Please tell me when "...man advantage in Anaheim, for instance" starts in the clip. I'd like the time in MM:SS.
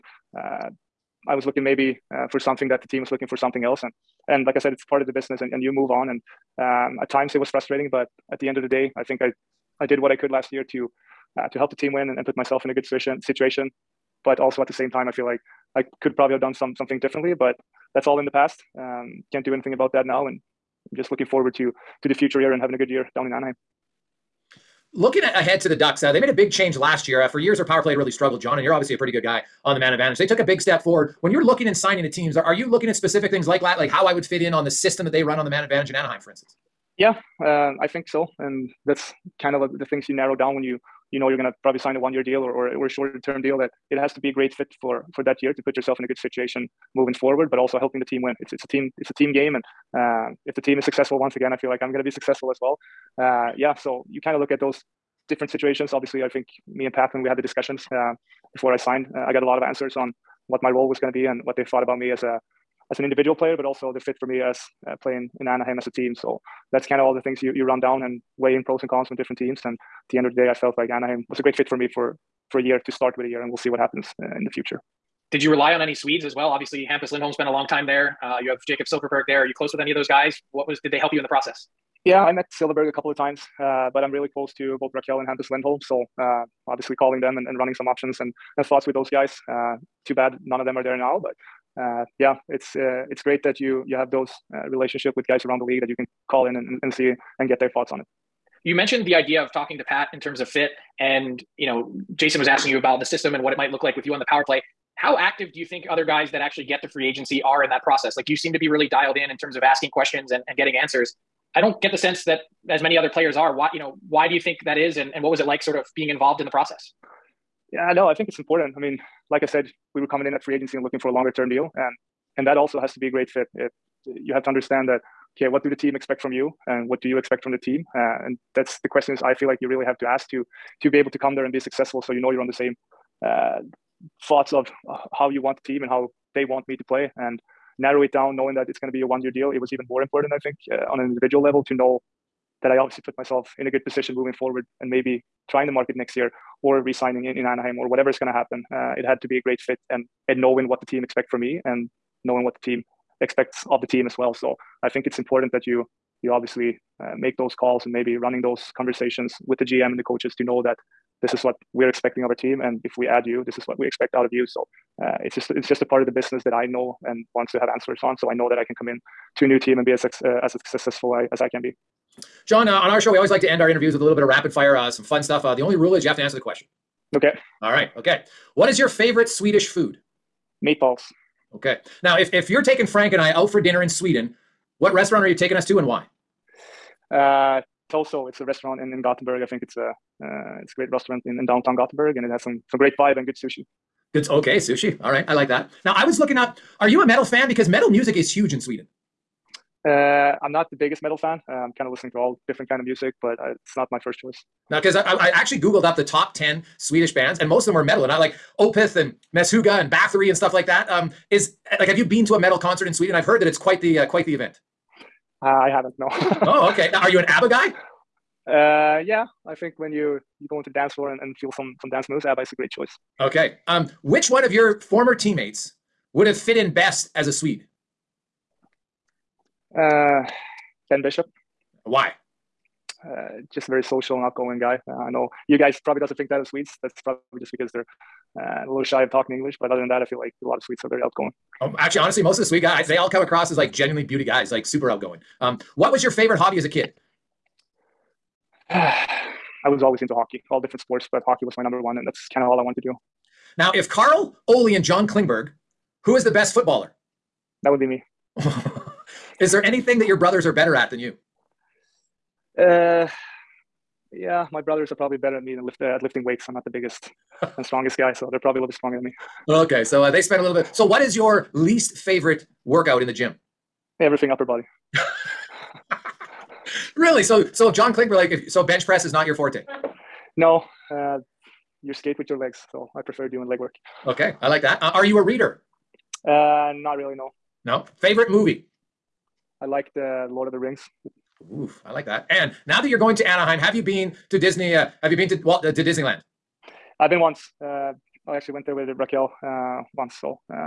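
00:35.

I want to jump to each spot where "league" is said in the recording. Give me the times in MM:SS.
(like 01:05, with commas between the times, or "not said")
01:35.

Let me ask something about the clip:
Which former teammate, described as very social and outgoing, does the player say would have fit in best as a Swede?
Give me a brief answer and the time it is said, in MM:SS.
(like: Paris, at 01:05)
Ben Bishop, at 03:50.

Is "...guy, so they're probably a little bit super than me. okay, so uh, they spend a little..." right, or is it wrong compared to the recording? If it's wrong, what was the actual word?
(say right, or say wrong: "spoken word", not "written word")
wrong: "stronger", not "super".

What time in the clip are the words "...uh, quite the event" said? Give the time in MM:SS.
03:33.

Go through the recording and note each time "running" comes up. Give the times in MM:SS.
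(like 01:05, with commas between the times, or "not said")
01:27, 02:38.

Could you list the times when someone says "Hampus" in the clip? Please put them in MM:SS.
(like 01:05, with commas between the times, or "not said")
01:16, 01:25.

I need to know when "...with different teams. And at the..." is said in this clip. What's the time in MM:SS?
01:09.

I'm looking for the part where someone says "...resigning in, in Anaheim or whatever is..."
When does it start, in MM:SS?
02:26.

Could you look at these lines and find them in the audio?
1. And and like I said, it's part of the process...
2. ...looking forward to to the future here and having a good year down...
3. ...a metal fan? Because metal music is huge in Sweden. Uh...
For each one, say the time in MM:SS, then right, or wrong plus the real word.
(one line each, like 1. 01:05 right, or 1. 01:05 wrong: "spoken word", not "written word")
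1. 00:03 wrong: "business", not "process"
2. 00:21 right
3. 03:17 right.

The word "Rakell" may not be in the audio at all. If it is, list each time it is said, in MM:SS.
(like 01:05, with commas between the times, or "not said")
01:24, 04:58.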